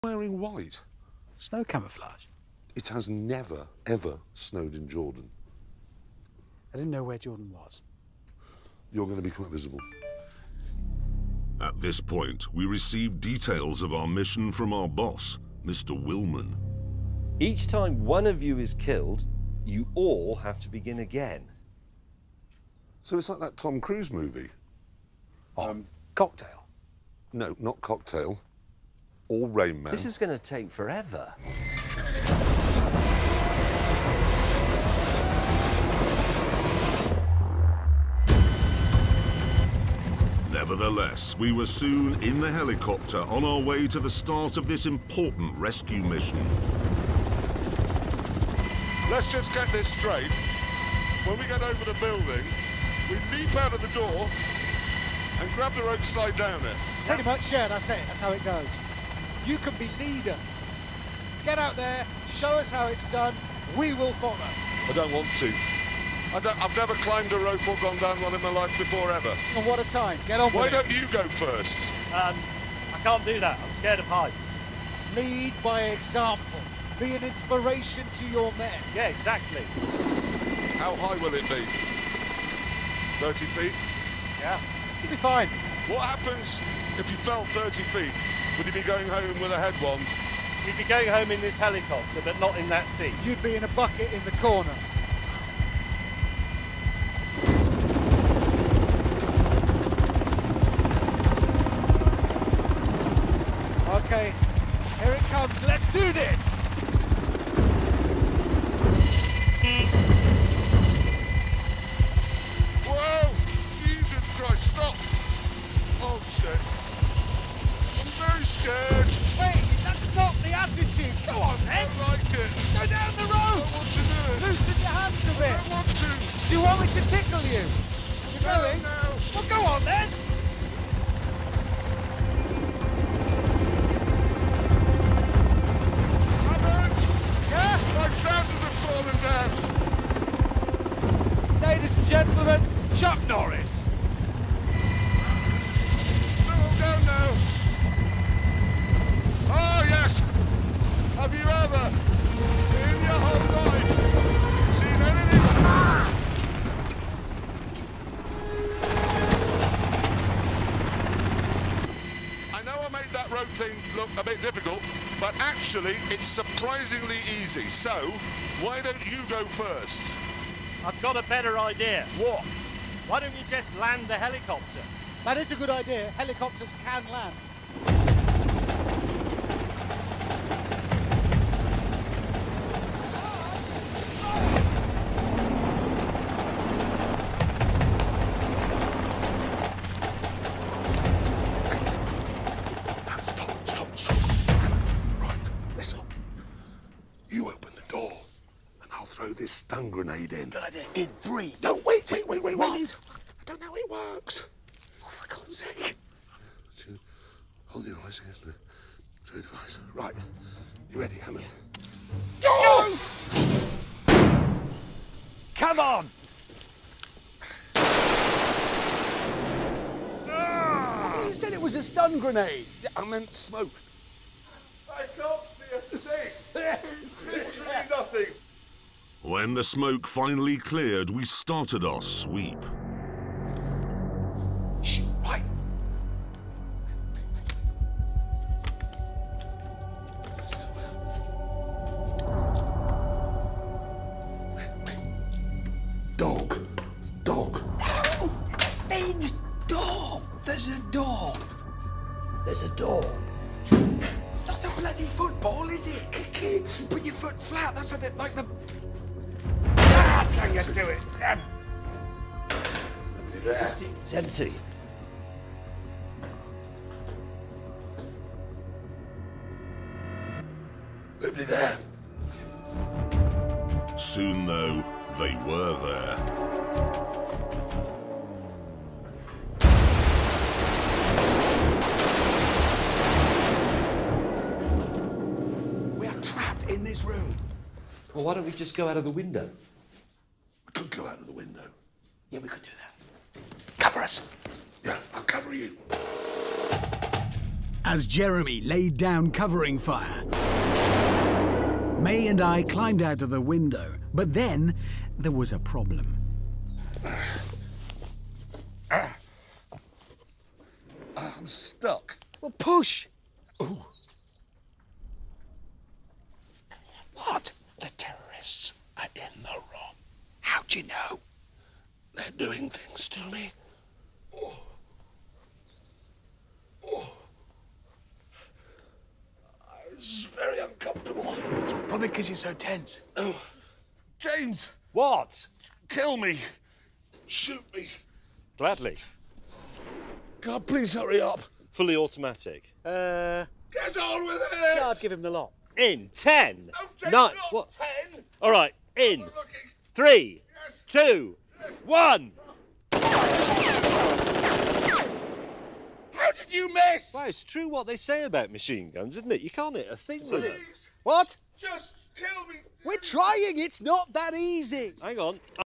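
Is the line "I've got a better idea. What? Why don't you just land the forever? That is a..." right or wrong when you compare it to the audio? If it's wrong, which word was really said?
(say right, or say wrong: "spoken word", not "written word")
wrong: "helicopter", not "forever".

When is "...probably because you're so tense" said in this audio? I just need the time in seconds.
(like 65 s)
331 s.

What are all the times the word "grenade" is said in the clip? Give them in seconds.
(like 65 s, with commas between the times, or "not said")
199 s, 222 s.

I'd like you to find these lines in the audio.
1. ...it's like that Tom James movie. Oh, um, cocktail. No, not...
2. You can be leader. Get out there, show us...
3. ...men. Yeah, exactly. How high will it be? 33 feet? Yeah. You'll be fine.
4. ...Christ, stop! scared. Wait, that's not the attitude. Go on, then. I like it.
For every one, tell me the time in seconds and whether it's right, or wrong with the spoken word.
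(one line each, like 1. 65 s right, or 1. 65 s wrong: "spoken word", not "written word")
1. 23 s wrong: "Cruise", not "James"
2. 59 s right
3. 78 s wrong: "30", not "33"
4. 114 s right.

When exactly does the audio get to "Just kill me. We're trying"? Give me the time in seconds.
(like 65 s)
361 s.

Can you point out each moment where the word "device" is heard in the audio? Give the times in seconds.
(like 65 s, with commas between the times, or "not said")
209 s.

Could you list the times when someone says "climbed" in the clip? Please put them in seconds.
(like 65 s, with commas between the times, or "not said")
67 s, 302 s.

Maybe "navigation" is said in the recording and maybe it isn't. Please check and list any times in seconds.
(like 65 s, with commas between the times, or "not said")
not said.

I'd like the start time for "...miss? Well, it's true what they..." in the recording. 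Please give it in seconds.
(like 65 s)
356 s.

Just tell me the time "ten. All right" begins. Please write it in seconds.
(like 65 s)
348 s.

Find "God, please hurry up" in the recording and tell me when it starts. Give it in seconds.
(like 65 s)
340 s.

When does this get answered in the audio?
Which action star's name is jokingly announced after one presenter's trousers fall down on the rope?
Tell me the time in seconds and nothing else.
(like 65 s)
142 s.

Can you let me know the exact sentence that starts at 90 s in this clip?
He'd be going home in this helicopter, but not in that seat.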